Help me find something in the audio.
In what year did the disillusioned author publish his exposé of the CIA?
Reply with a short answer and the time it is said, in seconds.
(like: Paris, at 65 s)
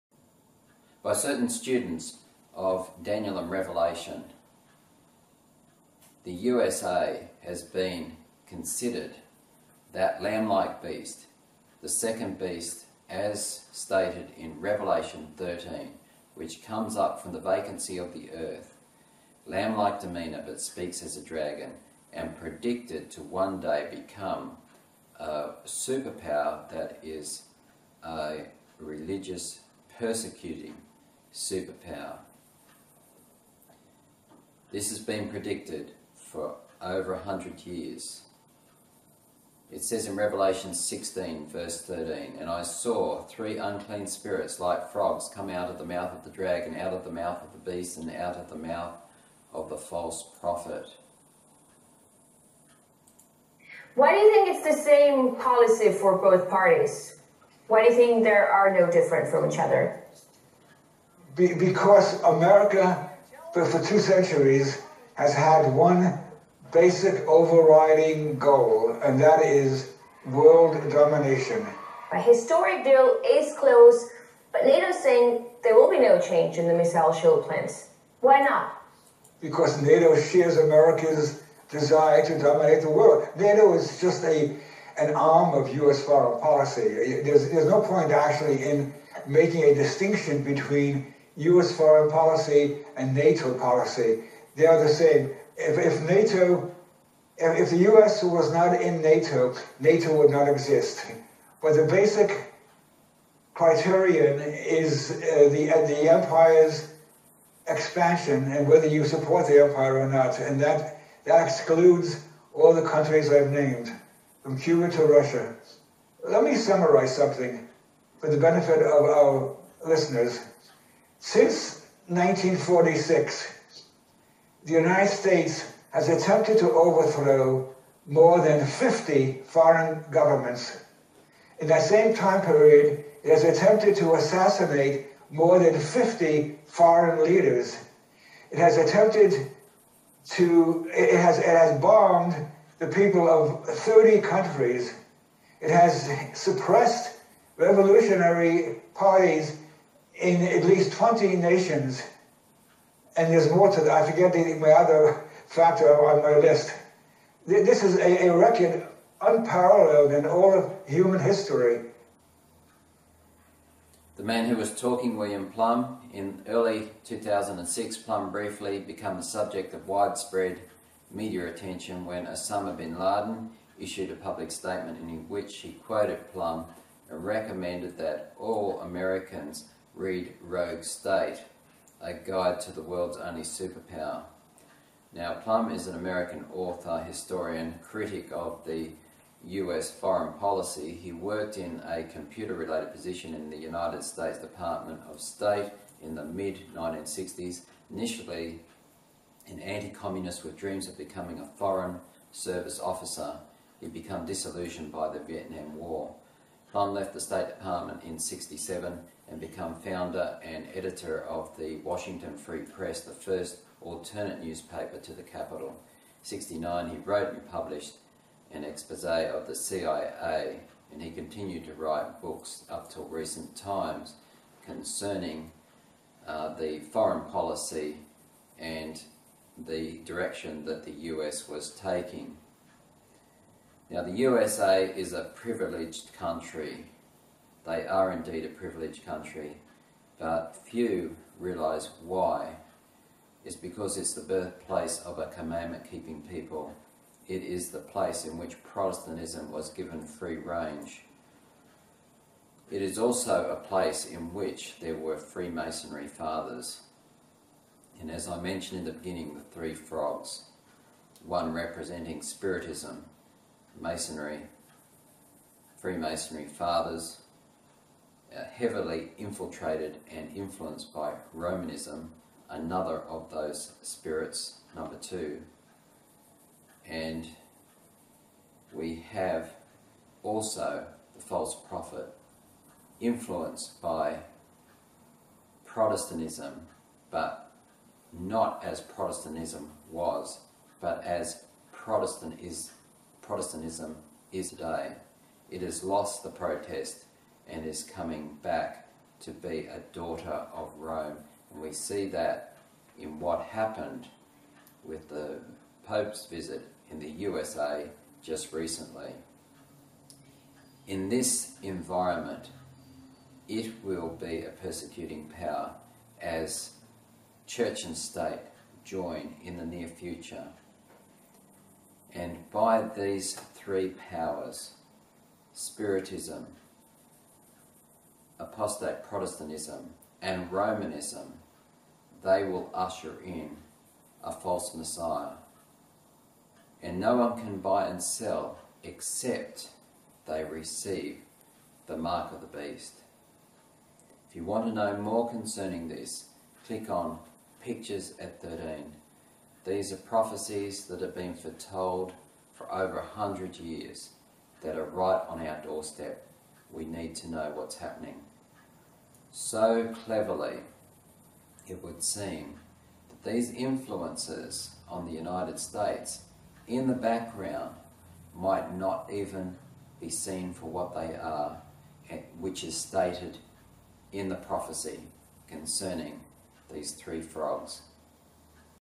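1969, at 216 s.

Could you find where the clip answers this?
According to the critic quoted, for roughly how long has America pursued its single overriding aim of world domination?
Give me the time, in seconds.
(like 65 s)
63 s.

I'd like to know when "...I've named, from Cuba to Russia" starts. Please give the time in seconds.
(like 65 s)
113 s.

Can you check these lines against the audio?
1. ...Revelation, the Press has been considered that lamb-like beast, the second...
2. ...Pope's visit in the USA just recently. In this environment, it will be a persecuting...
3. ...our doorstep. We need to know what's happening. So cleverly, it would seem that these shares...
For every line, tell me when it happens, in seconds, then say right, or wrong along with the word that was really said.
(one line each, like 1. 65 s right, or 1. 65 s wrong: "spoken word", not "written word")
1. 3 s wrong: "USA", not "Press"
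2. 305 s right
3. 355 s wrong: "influences", not "shares".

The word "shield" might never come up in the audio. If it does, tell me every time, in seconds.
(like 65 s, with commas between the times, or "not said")
77 s.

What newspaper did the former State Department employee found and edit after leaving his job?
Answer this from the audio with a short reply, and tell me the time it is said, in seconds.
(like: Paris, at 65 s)
Washington Free Press, at 211 s.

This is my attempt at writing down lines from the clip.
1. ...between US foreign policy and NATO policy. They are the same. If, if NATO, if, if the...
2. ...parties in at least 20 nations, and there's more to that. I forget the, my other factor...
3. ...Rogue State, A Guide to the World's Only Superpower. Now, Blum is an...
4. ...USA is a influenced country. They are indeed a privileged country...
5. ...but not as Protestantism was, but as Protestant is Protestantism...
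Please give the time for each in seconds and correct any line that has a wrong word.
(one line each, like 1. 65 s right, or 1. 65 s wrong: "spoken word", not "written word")
1. 90 s right
2. 148 s right
3. 180 s right
4. 234 s wrong: "privileged", not "influenced"
5. 287 s right.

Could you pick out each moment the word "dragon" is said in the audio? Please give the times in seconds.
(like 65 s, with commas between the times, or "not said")
21 s, 46 s.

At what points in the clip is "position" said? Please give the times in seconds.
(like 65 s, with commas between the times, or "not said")
192 s.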